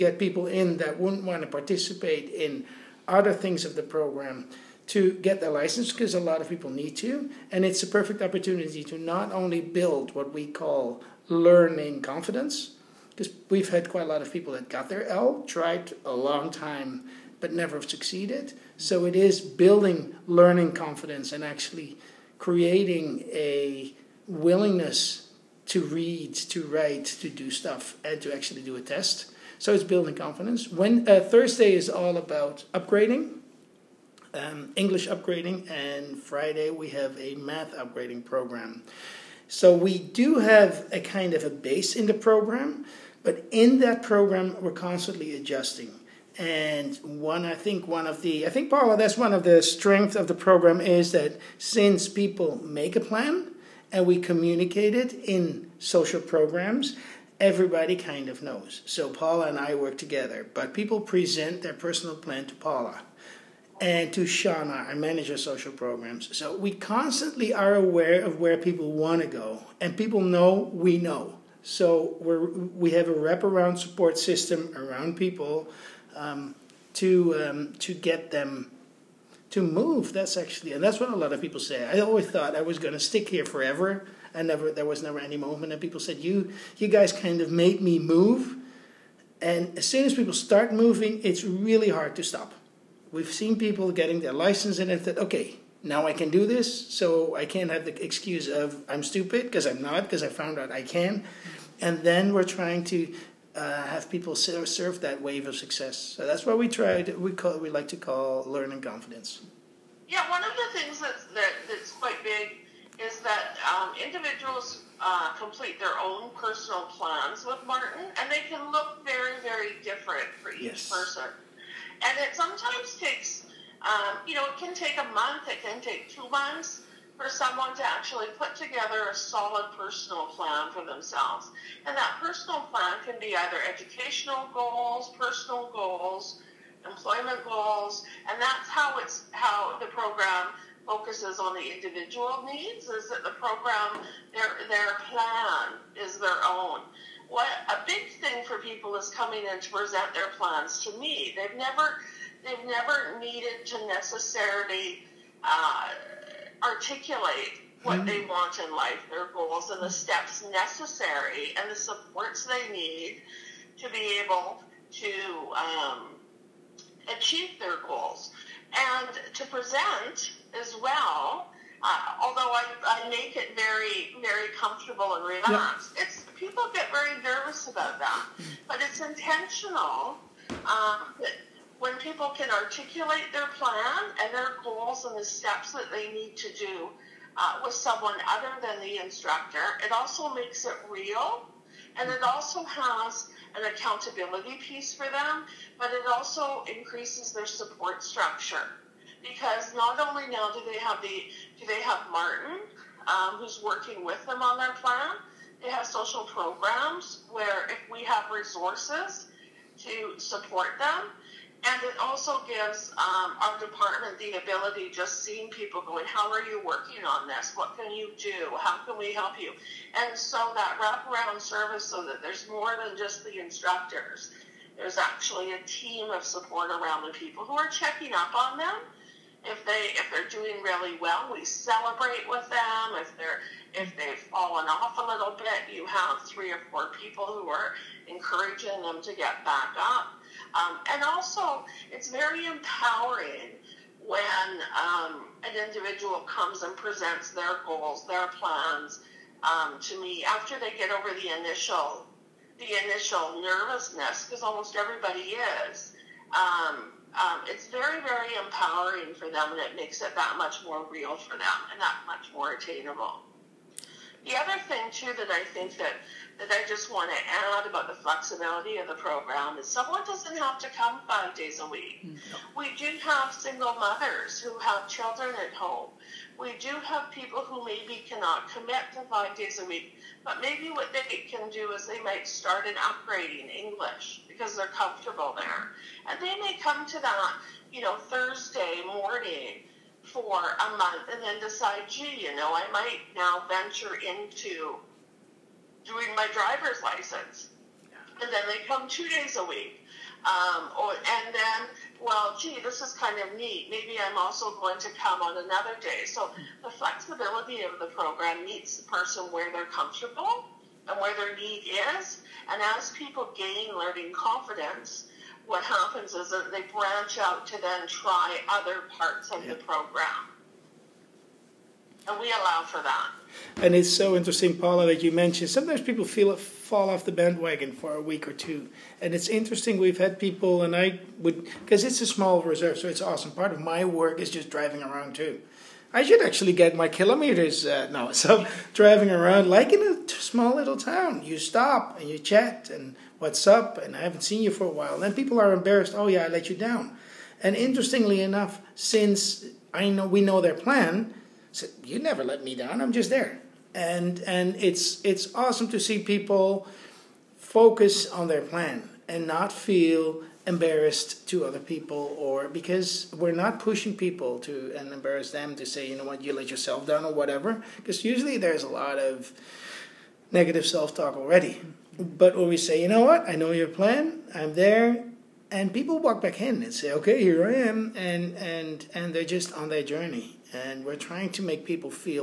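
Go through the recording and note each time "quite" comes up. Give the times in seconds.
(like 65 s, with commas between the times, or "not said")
13 s, 111 s.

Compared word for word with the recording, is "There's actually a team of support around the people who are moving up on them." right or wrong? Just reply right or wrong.
wrong.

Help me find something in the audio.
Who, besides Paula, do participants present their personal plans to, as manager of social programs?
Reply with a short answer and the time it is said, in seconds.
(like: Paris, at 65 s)
Shauna, at 64 s.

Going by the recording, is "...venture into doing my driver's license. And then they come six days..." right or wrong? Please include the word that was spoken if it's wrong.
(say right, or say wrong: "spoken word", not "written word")
wrong: "two", not "six".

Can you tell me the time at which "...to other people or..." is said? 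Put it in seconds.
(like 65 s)
361 s.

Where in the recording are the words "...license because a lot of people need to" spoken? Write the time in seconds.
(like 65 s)
5 s.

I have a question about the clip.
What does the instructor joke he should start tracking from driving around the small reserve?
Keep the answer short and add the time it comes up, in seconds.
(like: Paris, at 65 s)
Kilometers, at 336 s.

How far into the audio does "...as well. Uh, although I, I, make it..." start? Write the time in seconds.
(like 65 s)
170 s.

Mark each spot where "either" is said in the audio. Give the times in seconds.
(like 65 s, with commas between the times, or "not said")
133 s.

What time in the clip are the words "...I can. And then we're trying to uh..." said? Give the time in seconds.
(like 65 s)
100 s.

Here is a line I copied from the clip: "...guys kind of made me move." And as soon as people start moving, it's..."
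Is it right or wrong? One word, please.
right.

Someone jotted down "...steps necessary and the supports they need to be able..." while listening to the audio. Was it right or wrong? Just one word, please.
right.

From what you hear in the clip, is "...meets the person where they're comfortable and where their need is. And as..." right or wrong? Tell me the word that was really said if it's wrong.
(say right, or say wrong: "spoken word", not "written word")
right.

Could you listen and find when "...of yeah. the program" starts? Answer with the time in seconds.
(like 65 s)
319 s.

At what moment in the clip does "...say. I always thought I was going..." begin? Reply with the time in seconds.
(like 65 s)
81 s.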